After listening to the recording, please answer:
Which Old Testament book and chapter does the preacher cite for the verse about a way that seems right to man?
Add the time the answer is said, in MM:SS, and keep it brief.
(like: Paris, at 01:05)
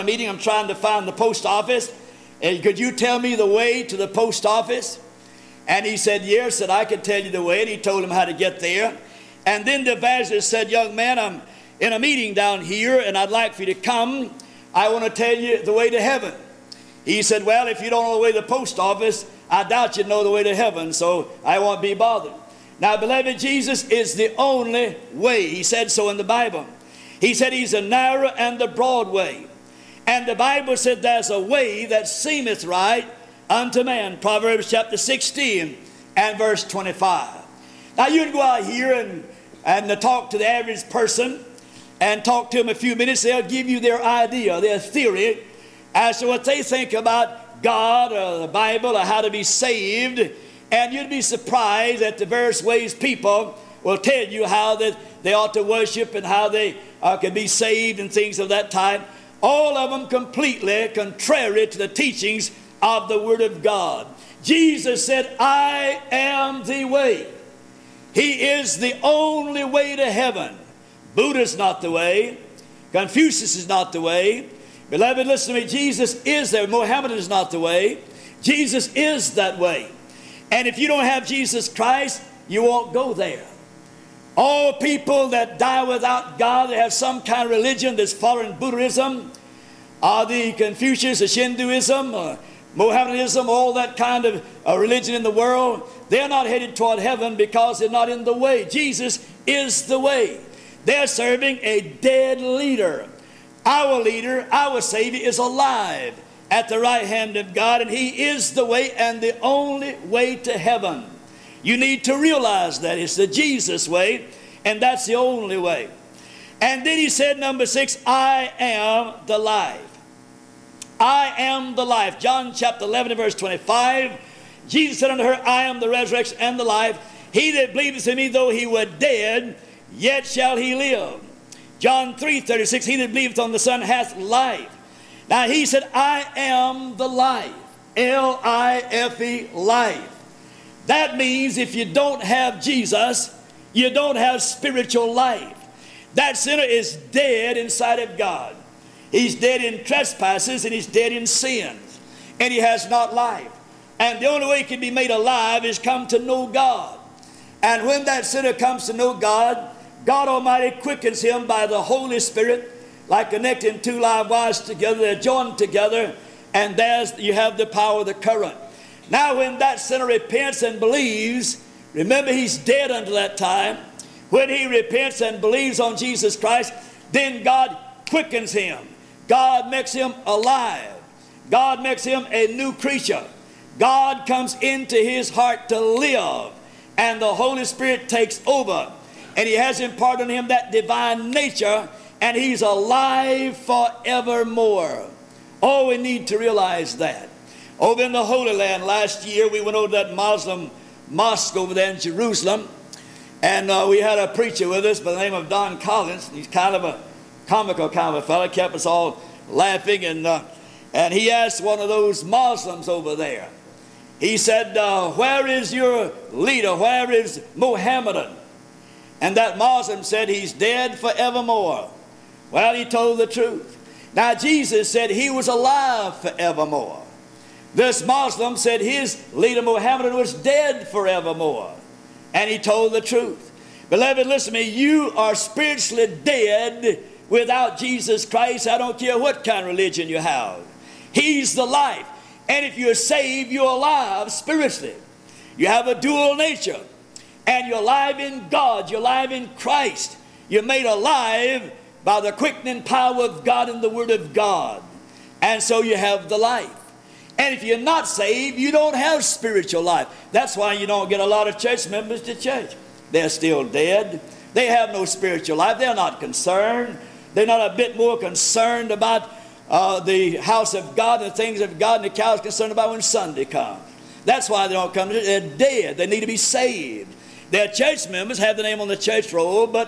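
Proverbs 16, at 00:34.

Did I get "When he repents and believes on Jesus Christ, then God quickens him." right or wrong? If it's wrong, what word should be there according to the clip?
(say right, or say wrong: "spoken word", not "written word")
right.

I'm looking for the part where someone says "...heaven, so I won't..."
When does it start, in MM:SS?
00:20.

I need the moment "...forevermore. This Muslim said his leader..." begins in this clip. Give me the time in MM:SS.
03:46.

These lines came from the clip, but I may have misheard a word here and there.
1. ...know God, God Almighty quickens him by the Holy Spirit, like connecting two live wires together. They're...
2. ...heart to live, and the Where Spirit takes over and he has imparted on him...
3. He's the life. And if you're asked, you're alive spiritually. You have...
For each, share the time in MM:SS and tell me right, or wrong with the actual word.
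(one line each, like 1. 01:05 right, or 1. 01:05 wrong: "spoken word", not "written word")
1. 02:38 right
2. 03:05 wrong: "Holy", not "Where"
3. 04:01 wrong: "saved", not "asked".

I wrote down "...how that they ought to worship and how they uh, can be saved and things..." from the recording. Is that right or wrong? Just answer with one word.
right.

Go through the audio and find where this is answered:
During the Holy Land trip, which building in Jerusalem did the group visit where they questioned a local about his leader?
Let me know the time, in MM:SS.
03:20.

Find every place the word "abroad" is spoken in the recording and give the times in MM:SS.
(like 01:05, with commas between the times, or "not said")
not said.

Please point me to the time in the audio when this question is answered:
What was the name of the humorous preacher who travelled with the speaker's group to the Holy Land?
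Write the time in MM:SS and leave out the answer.
03:25.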